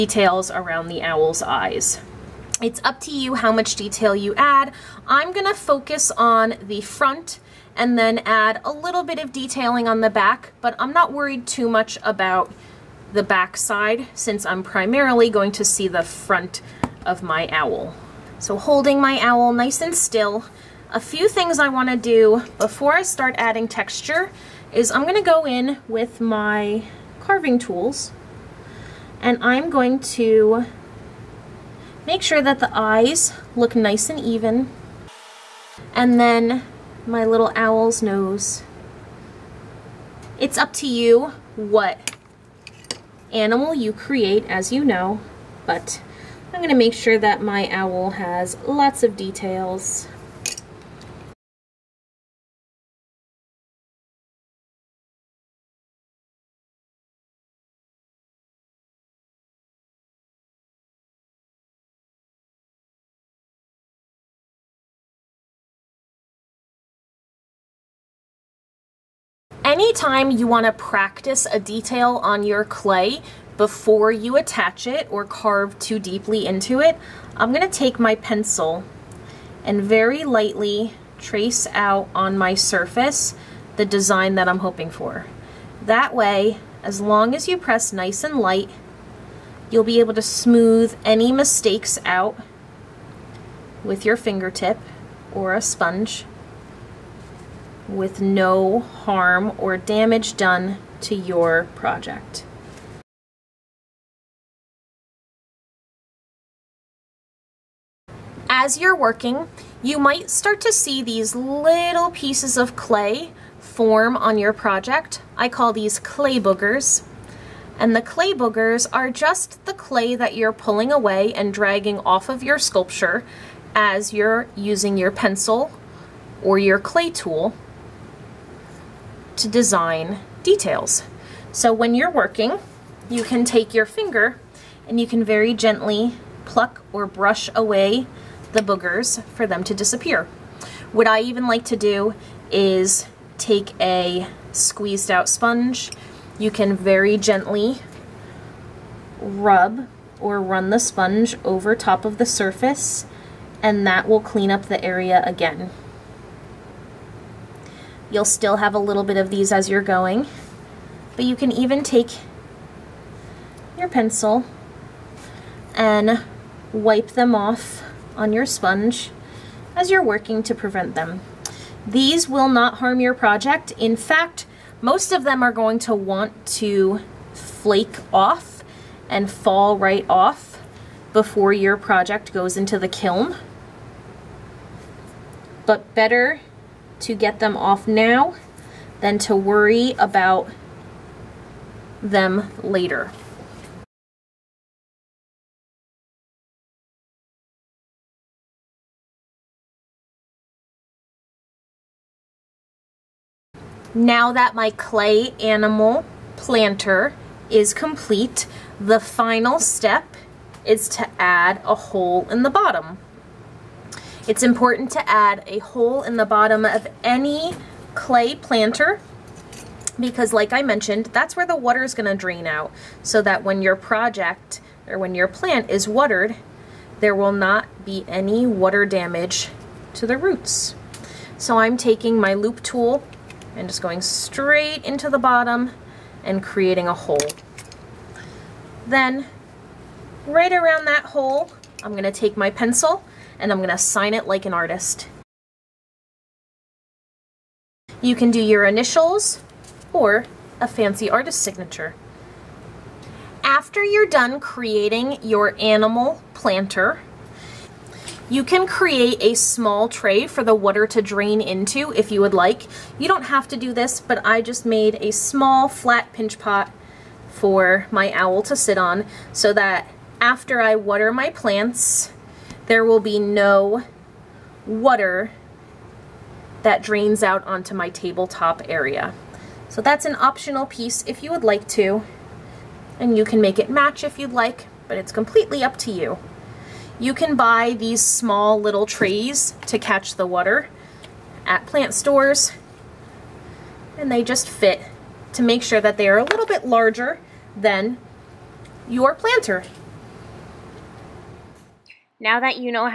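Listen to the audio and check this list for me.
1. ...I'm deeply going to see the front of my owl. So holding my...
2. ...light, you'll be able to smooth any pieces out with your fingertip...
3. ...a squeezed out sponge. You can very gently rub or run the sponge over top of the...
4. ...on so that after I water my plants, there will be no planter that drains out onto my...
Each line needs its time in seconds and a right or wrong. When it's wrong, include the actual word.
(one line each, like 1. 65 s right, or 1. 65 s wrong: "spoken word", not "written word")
1. 14 s wrong: "primarily", not "deeply"
2. 88 s wrong: "mistakes", not "pieces"
3. 143 s right
4. 268 s wrong: "water", not "planter".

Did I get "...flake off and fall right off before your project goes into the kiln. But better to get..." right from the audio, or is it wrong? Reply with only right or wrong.
right.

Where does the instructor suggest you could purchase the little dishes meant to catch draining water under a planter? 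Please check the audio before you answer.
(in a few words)
Plant stores.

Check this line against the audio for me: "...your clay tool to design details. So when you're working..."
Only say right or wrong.
right.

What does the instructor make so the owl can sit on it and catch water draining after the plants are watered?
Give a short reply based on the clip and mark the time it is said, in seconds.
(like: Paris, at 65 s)
Small flat pinch pot, at 265 s.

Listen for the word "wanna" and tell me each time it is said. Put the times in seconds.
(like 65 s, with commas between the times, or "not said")
21 s.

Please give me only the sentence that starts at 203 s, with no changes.
Now that my clay animal planter is complete, the final step is to add a hole in the bottom.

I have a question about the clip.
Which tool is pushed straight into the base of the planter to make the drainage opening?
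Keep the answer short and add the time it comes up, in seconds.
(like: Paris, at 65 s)
Loop tool, at 232 s.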